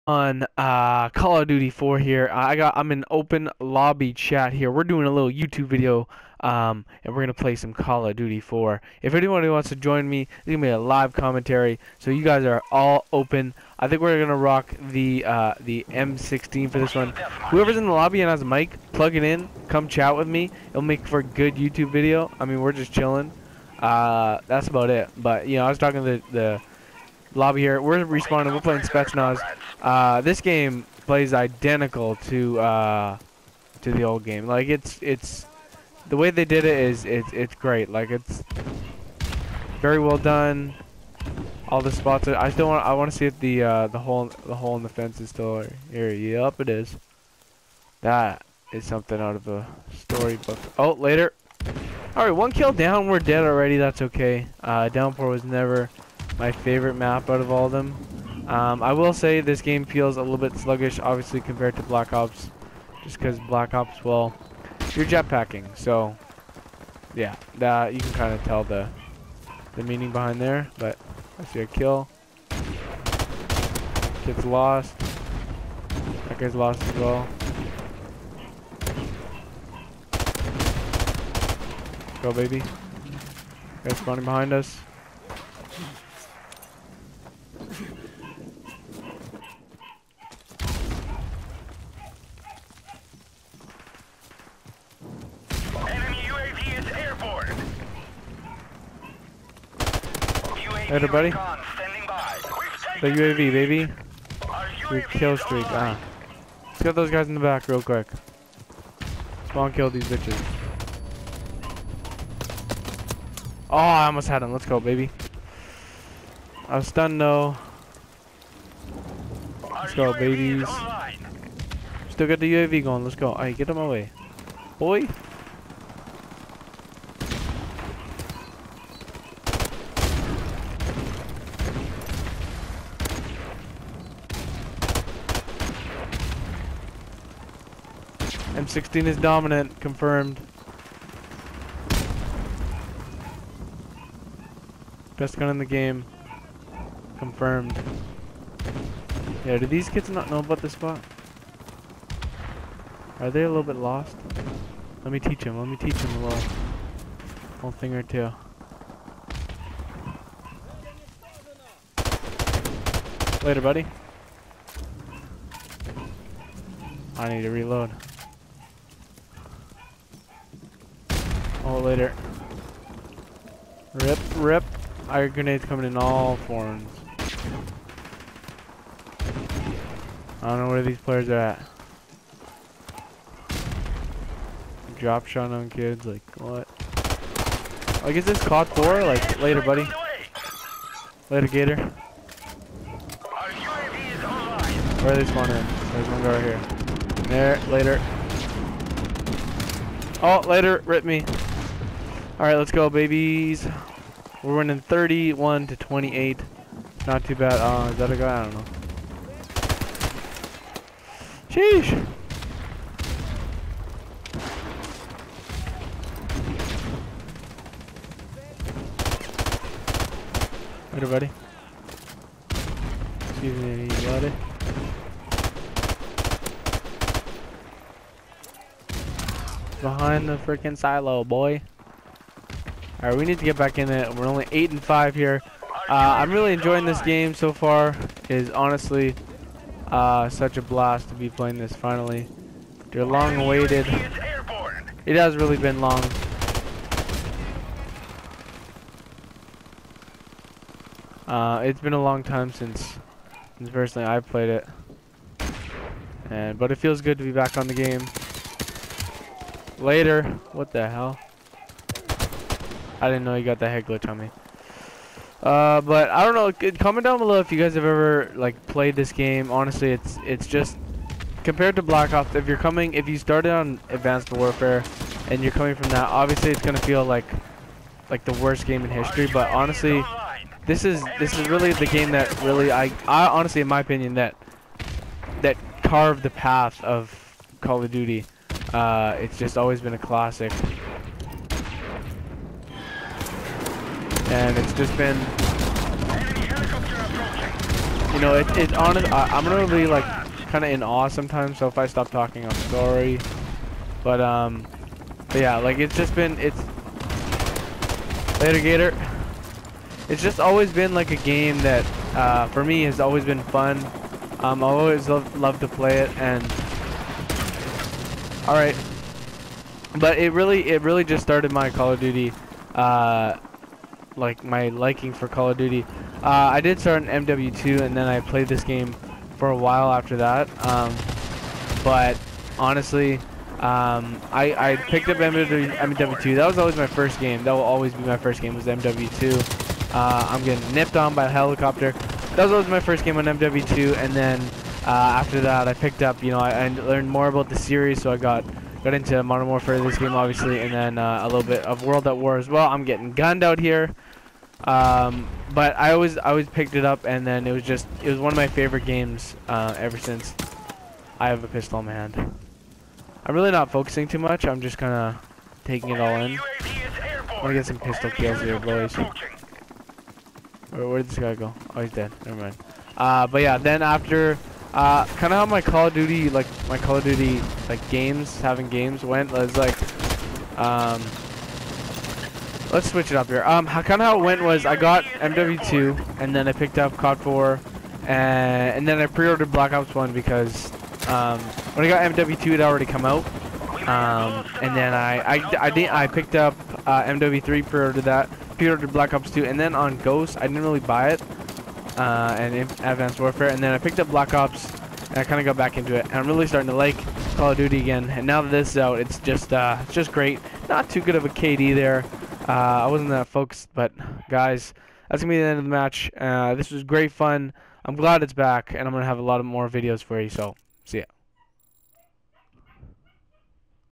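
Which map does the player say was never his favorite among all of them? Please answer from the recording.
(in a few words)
Downpour.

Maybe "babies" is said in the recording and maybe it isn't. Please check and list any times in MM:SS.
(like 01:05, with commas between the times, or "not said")
02:00, 03:22.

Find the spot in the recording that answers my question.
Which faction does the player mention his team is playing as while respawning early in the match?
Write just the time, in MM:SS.
00:28.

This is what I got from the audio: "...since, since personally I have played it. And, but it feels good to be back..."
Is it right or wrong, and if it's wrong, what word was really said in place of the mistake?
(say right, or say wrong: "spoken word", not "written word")
right.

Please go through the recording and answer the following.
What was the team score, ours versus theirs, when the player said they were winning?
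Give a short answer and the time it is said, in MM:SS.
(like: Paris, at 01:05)
31 to 28, at 03:24.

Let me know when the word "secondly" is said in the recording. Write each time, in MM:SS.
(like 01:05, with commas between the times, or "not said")
not said.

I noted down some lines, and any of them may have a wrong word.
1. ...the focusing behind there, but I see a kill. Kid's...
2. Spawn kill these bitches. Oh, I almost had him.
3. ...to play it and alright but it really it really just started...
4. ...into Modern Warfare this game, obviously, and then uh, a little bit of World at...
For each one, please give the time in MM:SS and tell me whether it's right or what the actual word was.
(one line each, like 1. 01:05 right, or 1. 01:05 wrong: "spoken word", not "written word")
1. 01:09 wrong: "meaning", not "focusing"
2. 01:49 right
3. 05:15 right
4. 05:48 right.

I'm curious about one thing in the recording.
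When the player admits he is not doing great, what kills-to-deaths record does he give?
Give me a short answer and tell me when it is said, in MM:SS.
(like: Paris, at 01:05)
8 and 5, at 03:54.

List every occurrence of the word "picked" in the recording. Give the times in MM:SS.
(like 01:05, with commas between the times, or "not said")
05:34, 05:45, 05:56, 06:26, 06:36, 06:43.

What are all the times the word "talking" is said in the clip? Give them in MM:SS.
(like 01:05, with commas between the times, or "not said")
00:25, 05:02.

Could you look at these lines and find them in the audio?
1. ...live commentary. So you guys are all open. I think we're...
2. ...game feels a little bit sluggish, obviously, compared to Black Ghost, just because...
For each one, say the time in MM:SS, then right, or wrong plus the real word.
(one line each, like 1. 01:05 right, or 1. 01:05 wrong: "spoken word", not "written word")
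1. 00:10 right
2. 00:59 wrong: "Ops", not "Ghost".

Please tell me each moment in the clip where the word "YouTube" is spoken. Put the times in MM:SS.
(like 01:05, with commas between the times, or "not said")
00:05, 00:21.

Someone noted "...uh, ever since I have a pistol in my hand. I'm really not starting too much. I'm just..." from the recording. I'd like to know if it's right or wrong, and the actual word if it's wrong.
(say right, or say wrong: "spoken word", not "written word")
wrong: "focusing", not "starting".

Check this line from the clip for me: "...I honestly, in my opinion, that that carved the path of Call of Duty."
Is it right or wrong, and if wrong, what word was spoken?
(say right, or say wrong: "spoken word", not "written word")
right.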